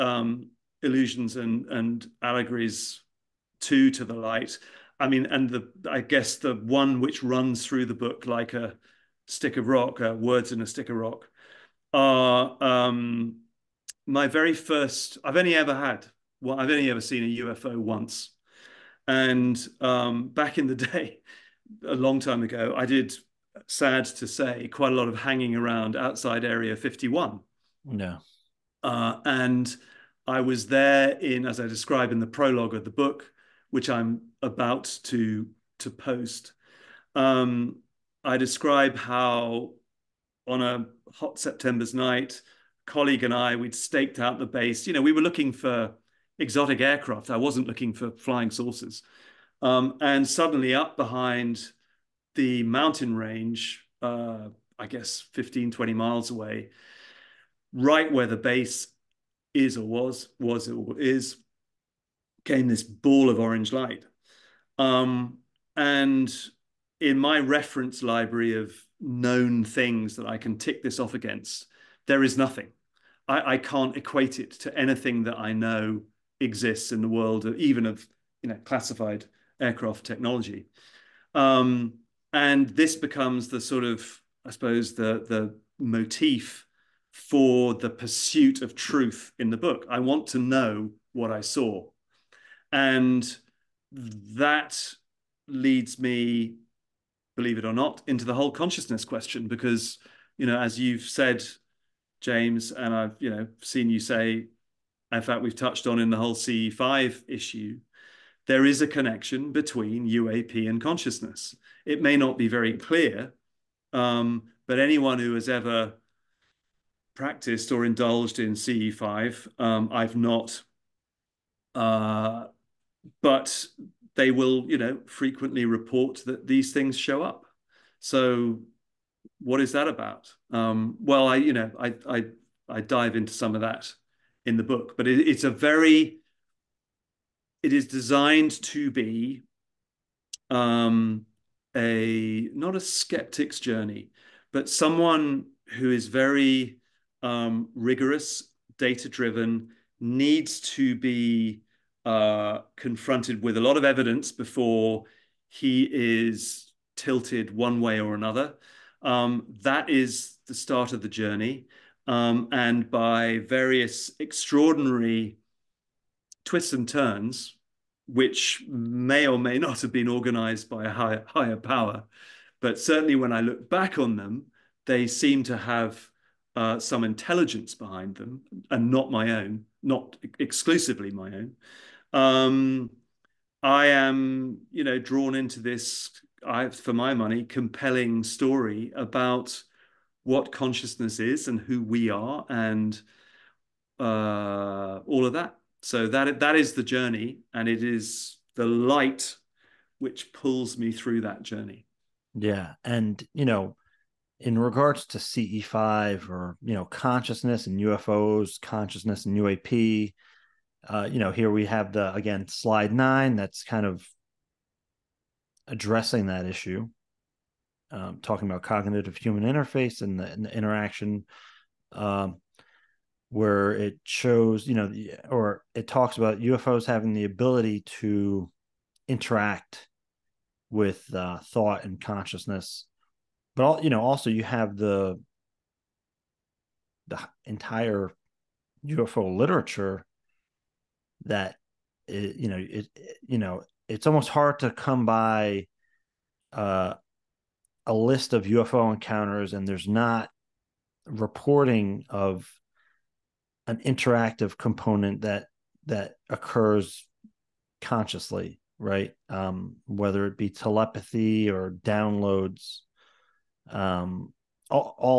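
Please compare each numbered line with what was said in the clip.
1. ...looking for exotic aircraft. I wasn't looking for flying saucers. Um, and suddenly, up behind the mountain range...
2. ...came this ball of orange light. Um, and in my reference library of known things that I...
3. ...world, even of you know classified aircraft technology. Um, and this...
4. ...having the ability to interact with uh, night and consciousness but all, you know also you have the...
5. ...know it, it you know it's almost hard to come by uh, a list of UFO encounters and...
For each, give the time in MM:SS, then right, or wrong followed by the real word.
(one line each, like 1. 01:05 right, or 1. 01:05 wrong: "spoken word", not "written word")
1. 00:45 right
2. 01:02 right
3. 01:17 right
4. 03:46 wrong: "thought", not "night"
5. 04:02 right.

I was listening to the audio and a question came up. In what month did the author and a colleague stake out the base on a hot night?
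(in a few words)
September.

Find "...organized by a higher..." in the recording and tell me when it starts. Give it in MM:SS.
02:50.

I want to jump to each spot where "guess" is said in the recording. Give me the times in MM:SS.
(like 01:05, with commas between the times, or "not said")
00:06, 00:54.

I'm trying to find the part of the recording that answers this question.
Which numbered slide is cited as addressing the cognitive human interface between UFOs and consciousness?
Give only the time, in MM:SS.
03:32.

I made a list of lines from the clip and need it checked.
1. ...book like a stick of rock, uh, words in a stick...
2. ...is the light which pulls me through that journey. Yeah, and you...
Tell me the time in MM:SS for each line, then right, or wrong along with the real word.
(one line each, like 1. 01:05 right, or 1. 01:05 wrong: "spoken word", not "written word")
1. 00:07 right
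2. 03:17 right.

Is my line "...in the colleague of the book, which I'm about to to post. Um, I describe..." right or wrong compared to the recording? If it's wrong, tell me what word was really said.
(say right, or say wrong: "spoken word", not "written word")
wrong: "prologue", not "colleague".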